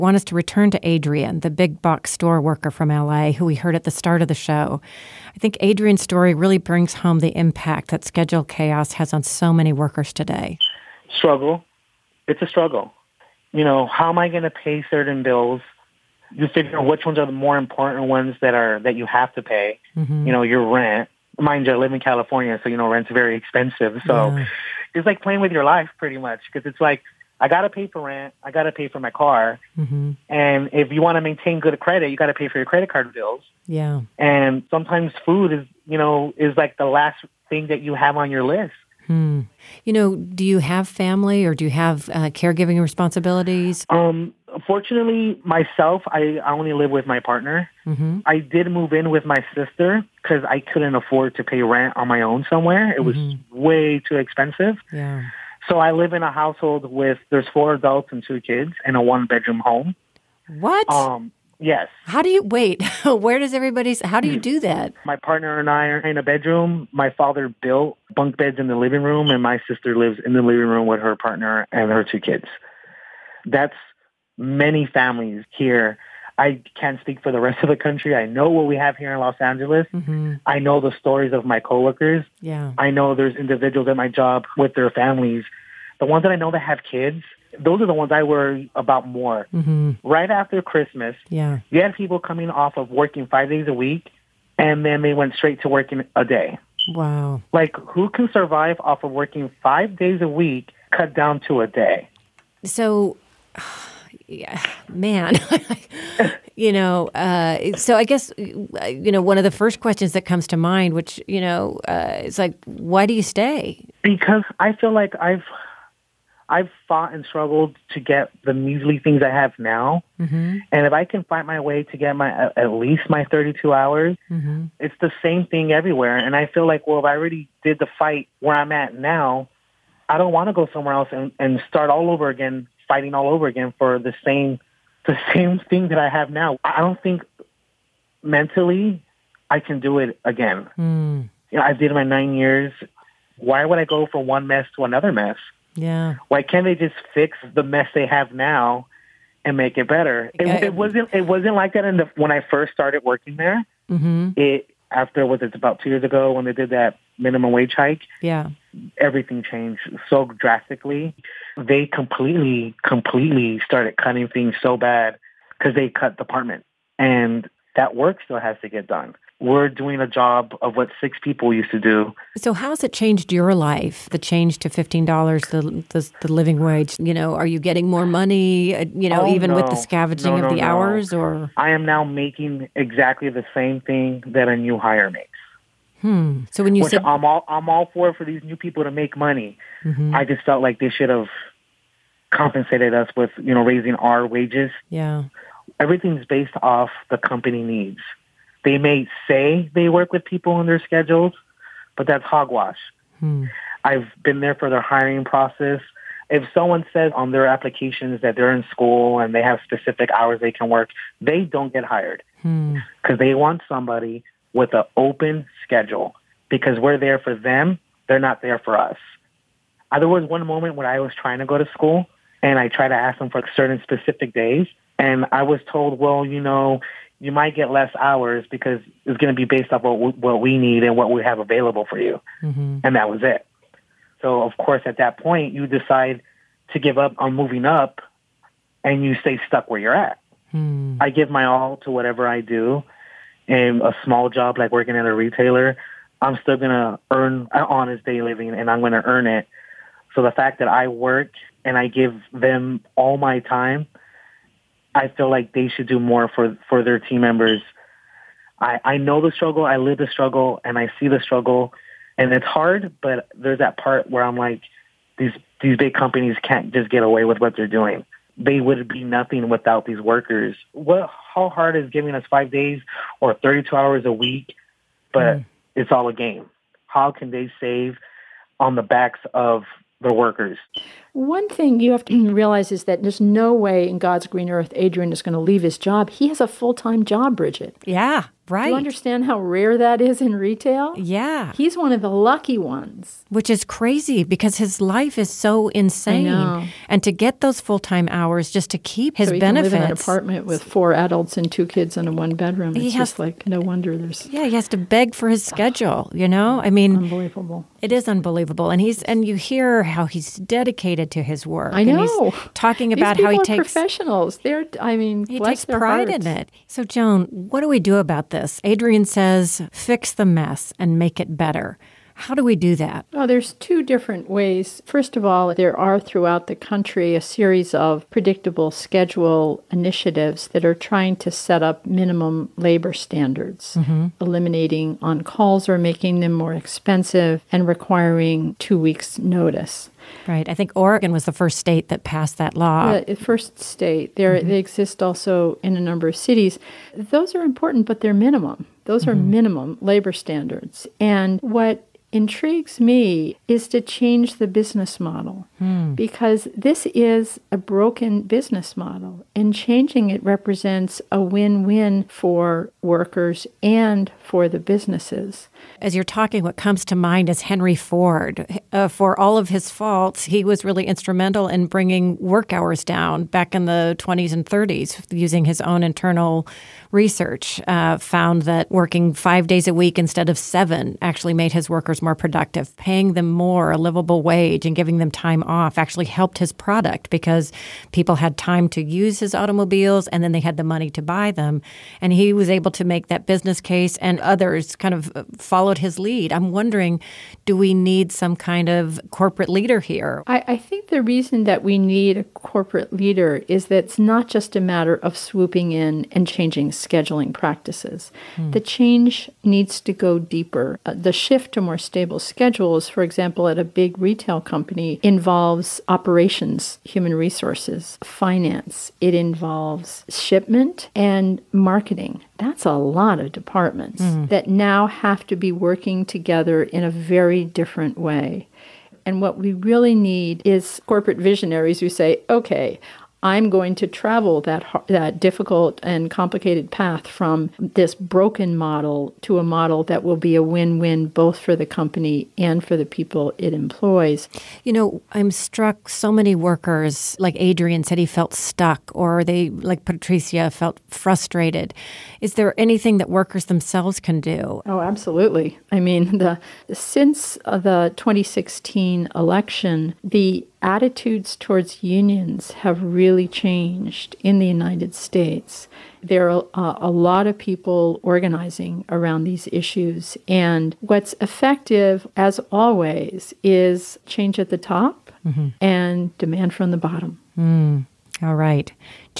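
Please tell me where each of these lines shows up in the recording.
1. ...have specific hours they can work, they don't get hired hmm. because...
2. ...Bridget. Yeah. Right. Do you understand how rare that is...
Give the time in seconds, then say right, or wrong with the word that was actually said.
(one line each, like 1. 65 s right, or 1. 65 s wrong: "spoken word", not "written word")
1. 209 s right
2. 287 s right.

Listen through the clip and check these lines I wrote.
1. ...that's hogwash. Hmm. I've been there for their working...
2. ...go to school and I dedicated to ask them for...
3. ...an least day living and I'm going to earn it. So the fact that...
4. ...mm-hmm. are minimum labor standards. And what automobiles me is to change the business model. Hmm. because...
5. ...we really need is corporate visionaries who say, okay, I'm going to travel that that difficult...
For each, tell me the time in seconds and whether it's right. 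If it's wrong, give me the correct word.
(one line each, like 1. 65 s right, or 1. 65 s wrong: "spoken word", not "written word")
1. 202 s wrong: "hiring", not "working"
2. 221 s wrong: "tried", not "dedicated"
3. 247 s wrong: "honest", not "least"
4. 349 s wrong: "intrigues", not "automobiles"
5. 429 s right.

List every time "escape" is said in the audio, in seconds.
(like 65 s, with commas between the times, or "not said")
not said.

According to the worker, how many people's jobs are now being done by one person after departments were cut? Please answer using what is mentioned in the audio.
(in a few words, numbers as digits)
6.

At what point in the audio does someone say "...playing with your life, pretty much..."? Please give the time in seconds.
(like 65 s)
25 s.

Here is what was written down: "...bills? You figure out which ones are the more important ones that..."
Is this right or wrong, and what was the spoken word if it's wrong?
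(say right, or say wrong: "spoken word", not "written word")
right.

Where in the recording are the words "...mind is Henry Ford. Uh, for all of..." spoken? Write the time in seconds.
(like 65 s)
366 s.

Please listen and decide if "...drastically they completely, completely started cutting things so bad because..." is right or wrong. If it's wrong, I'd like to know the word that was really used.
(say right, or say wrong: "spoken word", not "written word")
right.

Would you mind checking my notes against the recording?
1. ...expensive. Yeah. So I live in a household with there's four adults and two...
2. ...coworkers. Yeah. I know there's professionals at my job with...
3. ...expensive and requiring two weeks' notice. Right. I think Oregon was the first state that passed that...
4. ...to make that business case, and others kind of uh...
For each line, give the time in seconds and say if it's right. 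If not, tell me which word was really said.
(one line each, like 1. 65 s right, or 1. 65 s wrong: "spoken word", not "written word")
1. 54 s right
2. 81 s wrong: "individuals", not "professionals"
3. 336 s right
4. 392 s right.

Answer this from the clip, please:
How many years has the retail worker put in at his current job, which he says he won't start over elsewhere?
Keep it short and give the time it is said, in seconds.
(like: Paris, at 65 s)
9, at 142 s.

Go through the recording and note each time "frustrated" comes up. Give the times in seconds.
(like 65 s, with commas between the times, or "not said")
450 s.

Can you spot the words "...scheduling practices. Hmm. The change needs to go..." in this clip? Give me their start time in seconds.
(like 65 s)
406 s.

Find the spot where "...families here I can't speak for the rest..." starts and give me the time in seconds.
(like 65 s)
74 s.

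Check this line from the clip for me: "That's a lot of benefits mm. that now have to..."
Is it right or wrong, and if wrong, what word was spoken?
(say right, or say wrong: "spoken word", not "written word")
wrong: "departments", not "benefits".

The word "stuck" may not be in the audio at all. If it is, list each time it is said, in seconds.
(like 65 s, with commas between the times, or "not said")
239 s, 448 s.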